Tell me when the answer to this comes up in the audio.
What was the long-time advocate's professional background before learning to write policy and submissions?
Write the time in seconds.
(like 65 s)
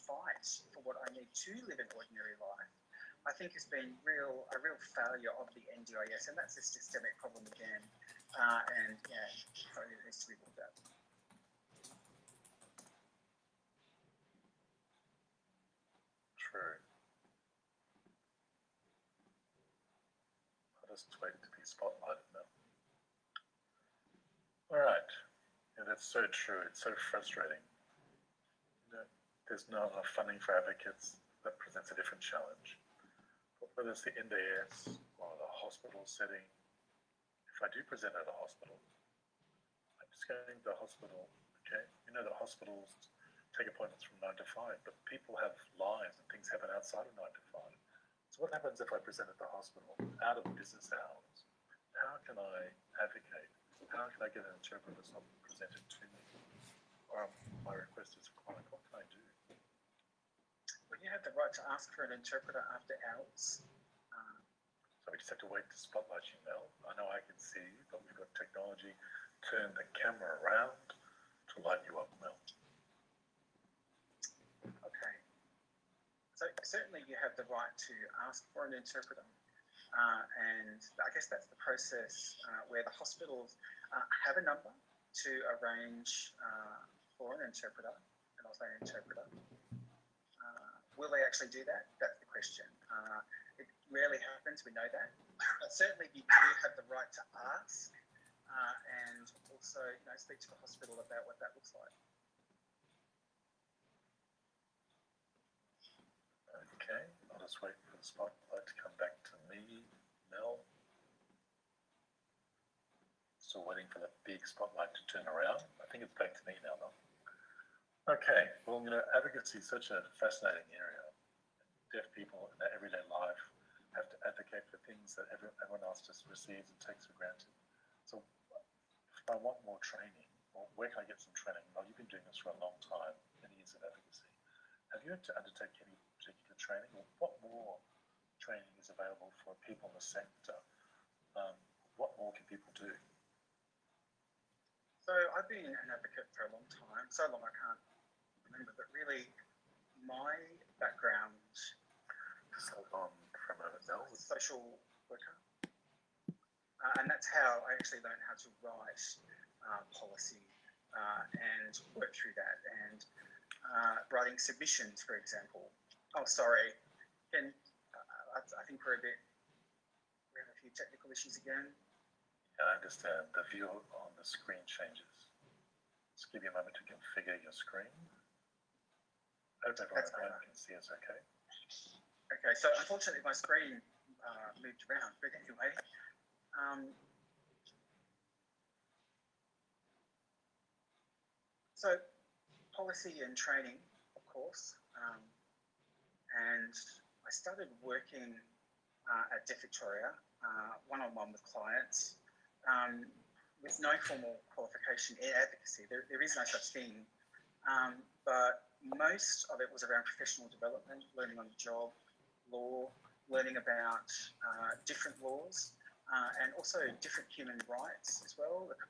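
154 s.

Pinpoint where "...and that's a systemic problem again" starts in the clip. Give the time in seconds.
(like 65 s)
6 s.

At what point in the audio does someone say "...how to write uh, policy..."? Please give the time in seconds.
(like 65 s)
158 s.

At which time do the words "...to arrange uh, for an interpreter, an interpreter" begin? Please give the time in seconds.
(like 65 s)
84 s.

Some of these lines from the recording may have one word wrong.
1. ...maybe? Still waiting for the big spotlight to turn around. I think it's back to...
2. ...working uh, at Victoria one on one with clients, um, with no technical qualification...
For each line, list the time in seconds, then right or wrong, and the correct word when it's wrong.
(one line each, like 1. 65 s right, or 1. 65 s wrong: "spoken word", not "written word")
1. 109 s right
2. 197 s wrong: "formal", not "technical".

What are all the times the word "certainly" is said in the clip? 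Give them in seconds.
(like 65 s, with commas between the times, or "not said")
76 s, 95 s.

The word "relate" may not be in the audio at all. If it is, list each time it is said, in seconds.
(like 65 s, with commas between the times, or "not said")
not said.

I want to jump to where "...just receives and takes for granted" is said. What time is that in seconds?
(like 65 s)
126 s.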